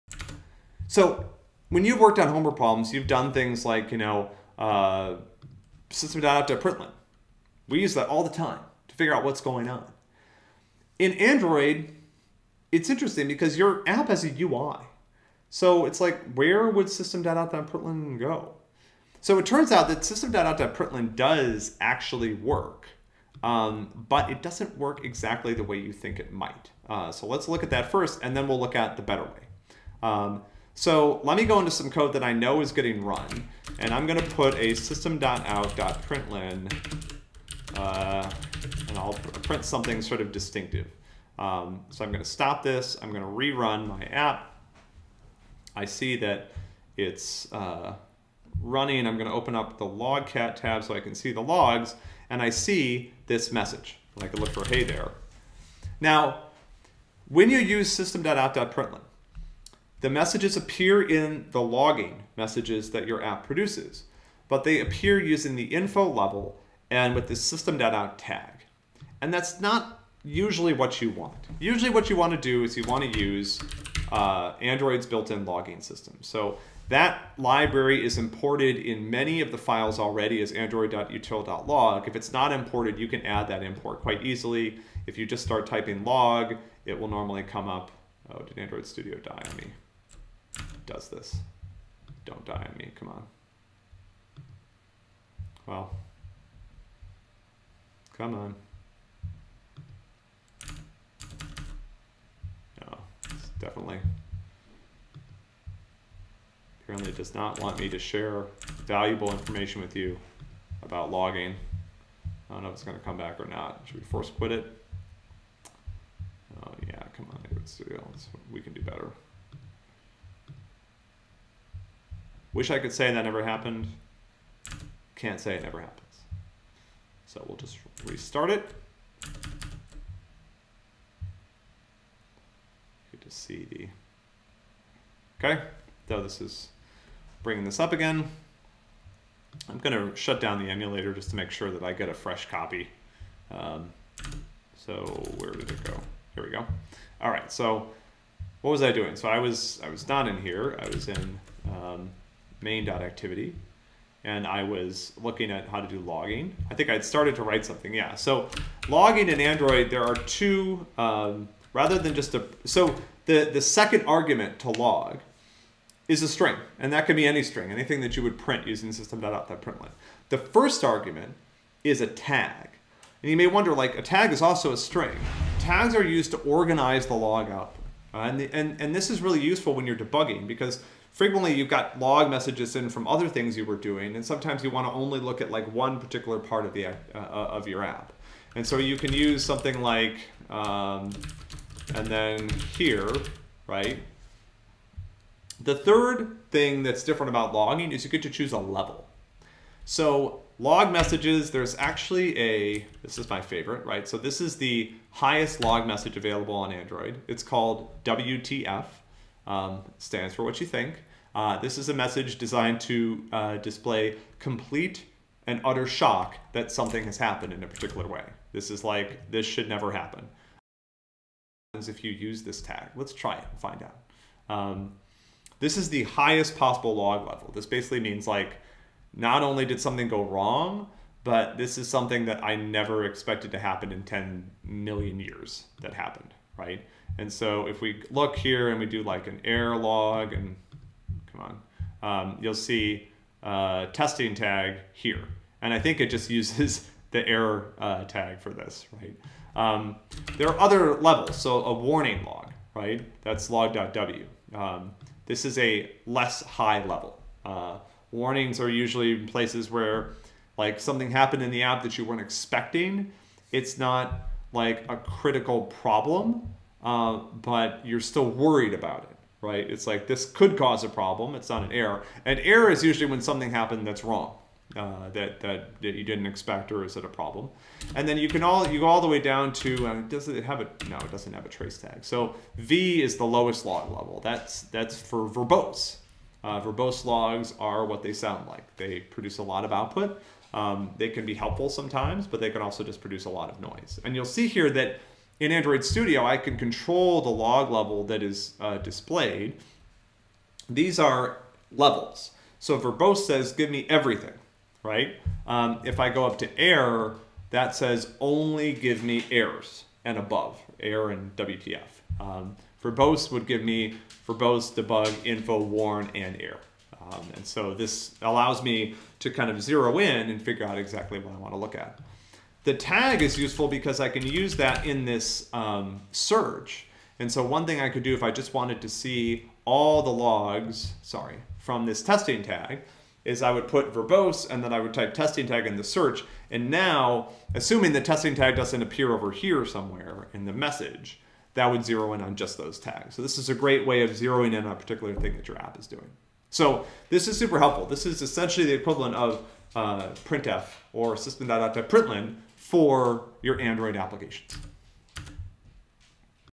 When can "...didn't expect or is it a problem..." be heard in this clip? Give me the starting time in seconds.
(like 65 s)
276 s.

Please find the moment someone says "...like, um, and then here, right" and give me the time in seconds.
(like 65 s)
189 s.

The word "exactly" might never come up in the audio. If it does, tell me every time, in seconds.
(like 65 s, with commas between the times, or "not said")
25 s, 320 s.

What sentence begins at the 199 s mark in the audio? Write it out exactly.
So log messages, there's actually a, this is my favorite, right?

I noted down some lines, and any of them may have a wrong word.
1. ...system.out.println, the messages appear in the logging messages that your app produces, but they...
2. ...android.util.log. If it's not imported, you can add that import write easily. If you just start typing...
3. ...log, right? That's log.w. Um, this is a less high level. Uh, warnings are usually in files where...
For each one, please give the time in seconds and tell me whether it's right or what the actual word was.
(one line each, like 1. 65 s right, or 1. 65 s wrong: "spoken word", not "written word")
1. 57 s right
2. 80 s wrong: "quite", not "write"
3. 252 s wrong: "places", not "files".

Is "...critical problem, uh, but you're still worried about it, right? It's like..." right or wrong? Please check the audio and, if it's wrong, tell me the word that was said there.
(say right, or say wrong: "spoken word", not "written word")
right.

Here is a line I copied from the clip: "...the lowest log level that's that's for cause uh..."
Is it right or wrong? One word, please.
wrong.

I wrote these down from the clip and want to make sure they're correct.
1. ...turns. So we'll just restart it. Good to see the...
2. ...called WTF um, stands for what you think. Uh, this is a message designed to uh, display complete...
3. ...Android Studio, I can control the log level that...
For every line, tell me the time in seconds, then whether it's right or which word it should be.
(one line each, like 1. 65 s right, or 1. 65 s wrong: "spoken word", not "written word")
1. 125 s wrong: "happens", not "turns"
2. 207 s right
3. 295 s right.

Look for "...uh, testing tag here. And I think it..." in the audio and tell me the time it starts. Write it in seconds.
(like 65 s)
243 s.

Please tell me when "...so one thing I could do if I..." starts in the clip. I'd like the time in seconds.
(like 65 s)
327 s.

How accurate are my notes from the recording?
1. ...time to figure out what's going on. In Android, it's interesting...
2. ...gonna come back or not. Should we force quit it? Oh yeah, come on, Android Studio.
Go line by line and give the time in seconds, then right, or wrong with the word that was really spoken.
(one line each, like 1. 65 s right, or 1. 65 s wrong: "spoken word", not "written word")
1. 8 s right
2. 112 s right.